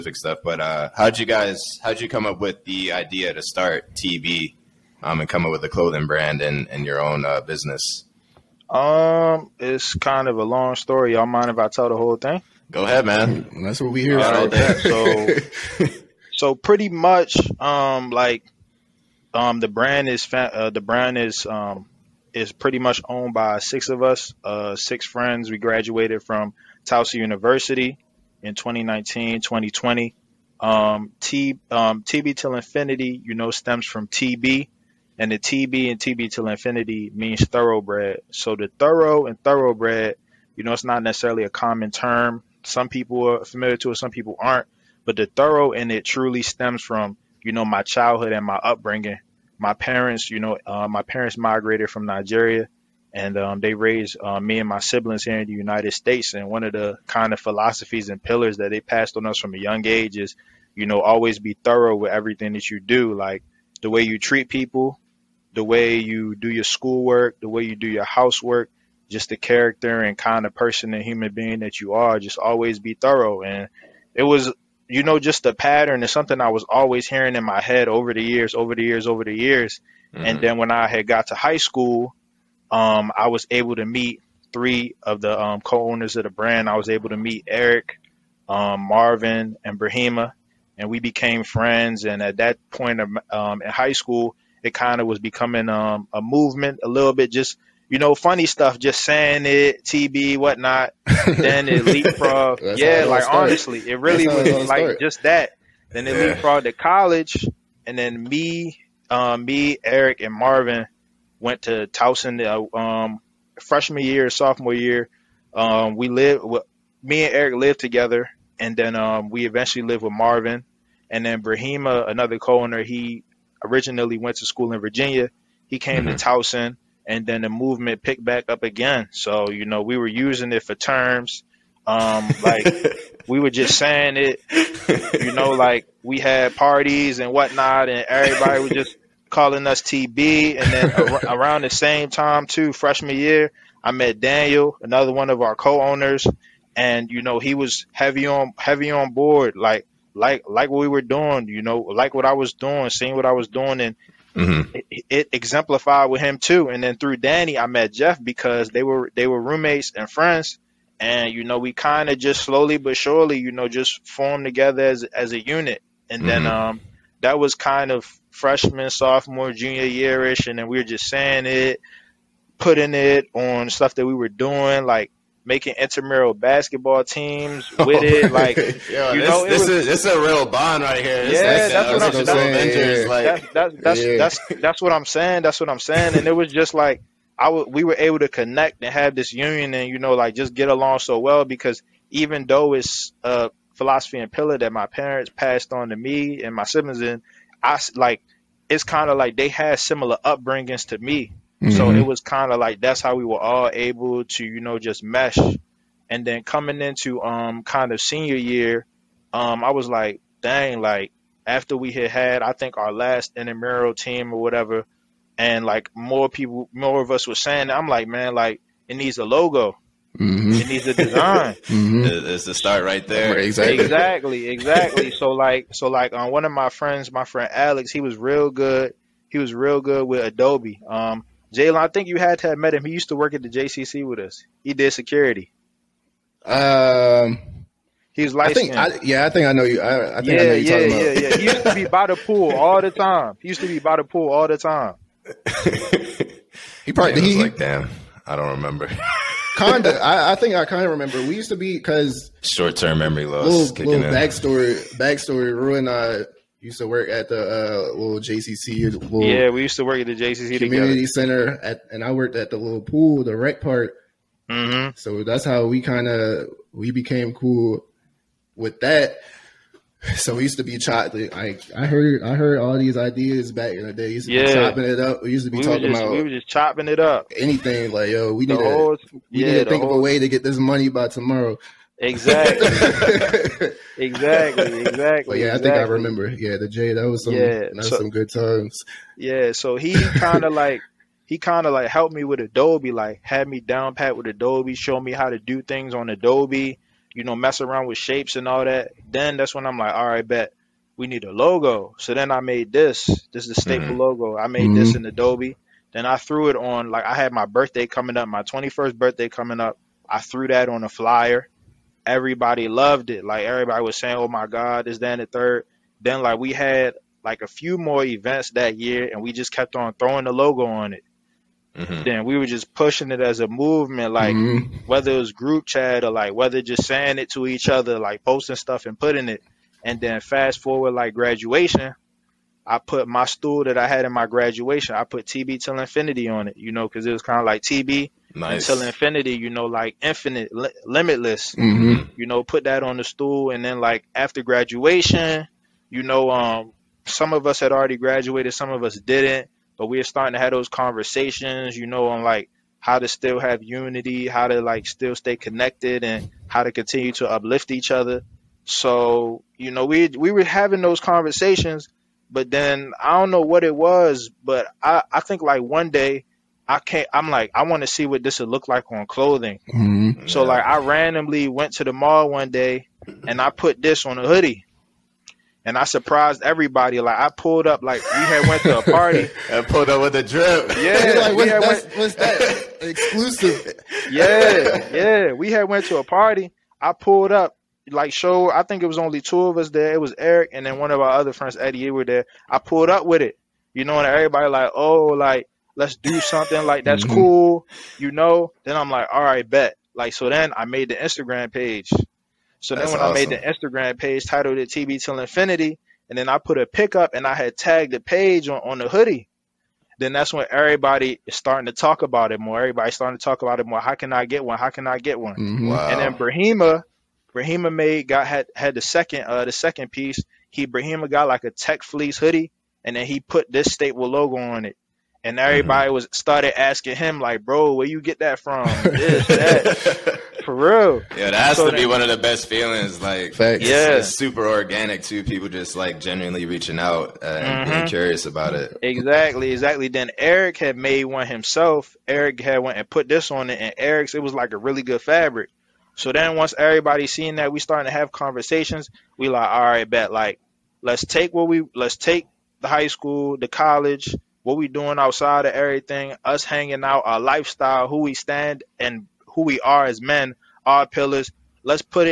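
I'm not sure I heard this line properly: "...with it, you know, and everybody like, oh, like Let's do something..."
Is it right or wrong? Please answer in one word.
right.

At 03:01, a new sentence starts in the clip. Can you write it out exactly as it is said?
This, yeah, that's, uh, what that's, yeah.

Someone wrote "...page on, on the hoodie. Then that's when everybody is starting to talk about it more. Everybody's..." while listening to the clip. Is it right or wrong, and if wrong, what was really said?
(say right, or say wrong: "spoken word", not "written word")
right.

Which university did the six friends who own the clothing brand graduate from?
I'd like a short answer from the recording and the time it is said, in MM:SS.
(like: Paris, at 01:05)
Towson University, at 00:26.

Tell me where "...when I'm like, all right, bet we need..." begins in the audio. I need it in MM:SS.
04:59.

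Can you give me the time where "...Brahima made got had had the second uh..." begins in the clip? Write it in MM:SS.
06:57.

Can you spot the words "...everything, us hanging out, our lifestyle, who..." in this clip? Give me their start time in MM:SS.
07:35.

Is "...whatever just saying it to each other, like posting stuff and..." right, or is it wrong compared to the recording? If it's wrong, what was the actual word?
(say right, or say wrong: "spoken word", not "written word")
wrong: "whether", not "whatever".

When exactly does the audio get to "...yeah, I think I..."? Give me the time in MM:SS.
03:59.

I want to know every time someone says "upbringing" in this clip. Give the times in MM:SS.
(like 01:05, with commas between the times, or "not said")
00:48, 03:20.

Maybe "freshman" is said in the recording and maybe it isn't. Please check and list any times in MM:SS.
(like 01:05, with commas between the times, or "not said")
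01:53, 02:22, 02:48.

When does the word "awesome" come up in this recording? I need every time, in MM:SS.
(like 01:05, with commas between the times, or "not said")
06:43.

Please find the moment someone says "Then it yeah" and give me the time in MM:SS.
01:45.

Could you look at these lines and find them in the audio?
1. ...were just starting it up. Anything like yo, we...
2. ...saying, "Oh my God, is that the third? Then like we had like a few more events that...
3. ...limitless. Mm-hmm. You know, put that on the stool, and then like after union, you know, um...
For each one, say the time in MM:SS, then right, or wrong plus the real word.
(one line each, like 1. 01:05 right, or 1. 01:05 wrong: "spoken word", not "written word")
1. 04:36 wrong: "chopping", not "starting"
2. 05:13 right
3. 05:40 wrong: "graduation", not "union".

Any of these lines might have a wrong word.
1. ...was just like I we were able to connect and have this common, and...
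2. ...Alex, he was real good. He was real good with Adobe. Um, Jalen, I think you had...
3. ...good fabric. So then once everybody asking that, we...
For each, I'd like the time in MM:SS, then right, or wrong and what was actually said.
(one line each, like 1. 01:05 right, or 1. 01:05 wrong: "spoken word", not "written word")
1. 03:06 wrong: "union", not "common"
2. 03:47 right
3. 07:24 wrong: "seeing", not "asking".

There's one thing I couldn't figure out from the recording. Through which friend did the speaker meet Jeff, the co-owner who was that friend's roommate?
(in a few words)
Danny.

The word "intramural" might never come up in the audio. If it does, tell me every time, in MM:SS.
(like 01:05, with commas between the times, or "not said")
02:55, 03:33.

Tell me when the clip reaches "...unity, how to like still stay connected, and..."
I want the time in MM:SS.
05:53.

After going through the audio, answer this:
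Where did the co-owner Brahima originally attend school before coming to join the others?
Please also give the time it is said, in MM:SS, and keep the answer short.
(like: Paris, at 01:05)
Virginia, at 02:04.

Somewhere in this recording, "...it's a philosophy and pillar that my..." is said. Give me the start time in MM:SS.
03:12.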